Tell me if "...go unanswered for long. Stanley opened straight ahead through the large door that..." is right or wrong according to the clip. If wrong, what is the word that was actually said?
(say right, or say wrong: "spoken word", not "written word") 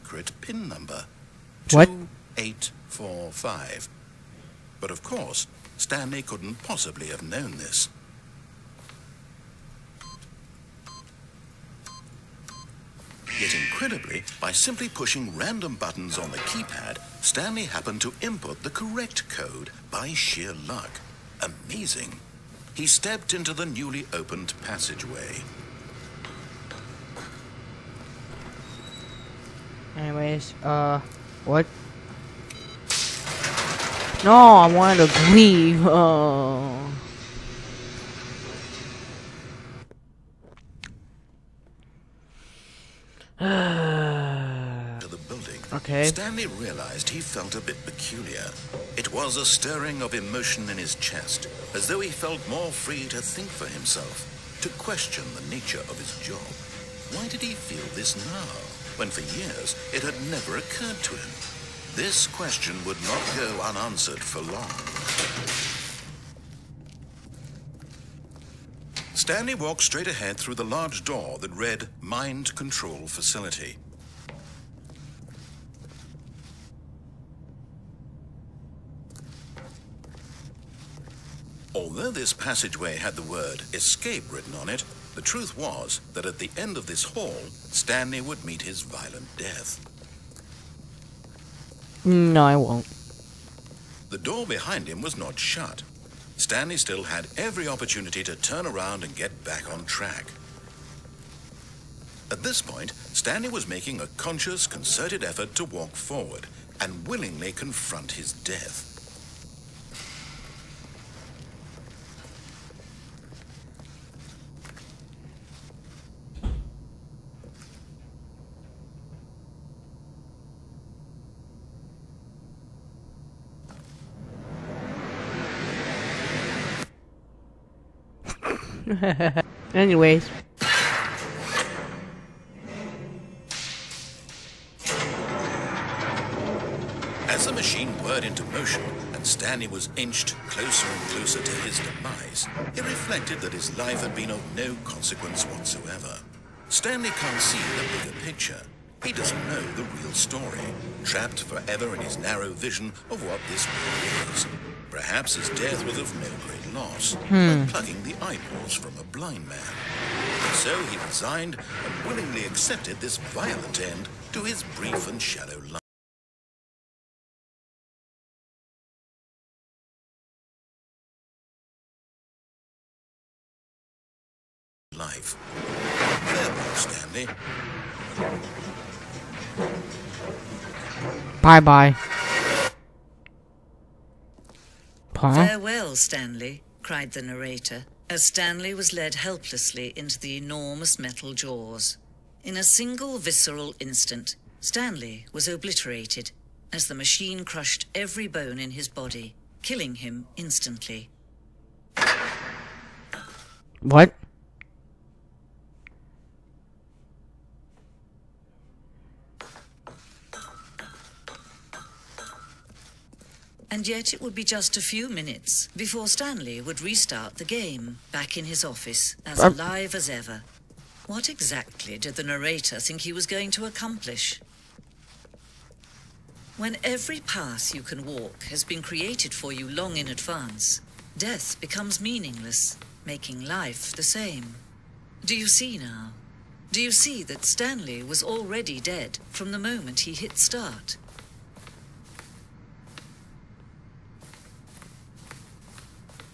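wrong: "walked", not "opened".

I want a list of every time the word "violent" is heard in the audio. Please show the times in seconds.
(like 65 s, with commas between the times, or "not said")
88 s, 163 s.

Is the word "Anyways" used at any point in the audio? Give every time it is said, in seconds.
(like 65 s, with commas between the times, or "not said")
29 s, 129 s.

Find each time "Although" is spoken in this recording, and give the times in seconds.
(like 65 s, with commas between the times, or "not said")
81 s.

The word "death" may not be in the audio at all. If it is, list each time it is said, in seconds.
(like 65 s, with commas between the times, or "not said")
89 s, 108 s, 155 s, 231 s.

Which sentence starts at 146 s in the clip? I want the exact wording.
Stanley can't see the bigger picture.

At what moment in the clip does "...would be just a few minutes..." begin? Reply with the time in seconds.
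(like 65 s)
214 s.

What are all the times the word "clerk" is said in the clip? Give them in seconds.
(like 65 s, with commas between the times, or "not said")
not said.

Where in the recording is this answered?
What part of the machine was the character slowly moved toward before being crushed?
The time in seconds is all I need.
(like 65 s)
190 s.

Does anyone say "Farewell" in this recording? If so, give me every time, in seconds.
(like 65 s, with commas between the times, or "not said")
176 s, 185 s.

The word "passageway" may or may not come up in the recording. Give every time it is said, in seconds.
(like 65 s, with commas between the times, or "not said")
24 s, 82 s.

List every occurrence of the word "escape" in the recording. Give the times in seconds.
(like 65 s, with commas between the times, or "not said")
83 s.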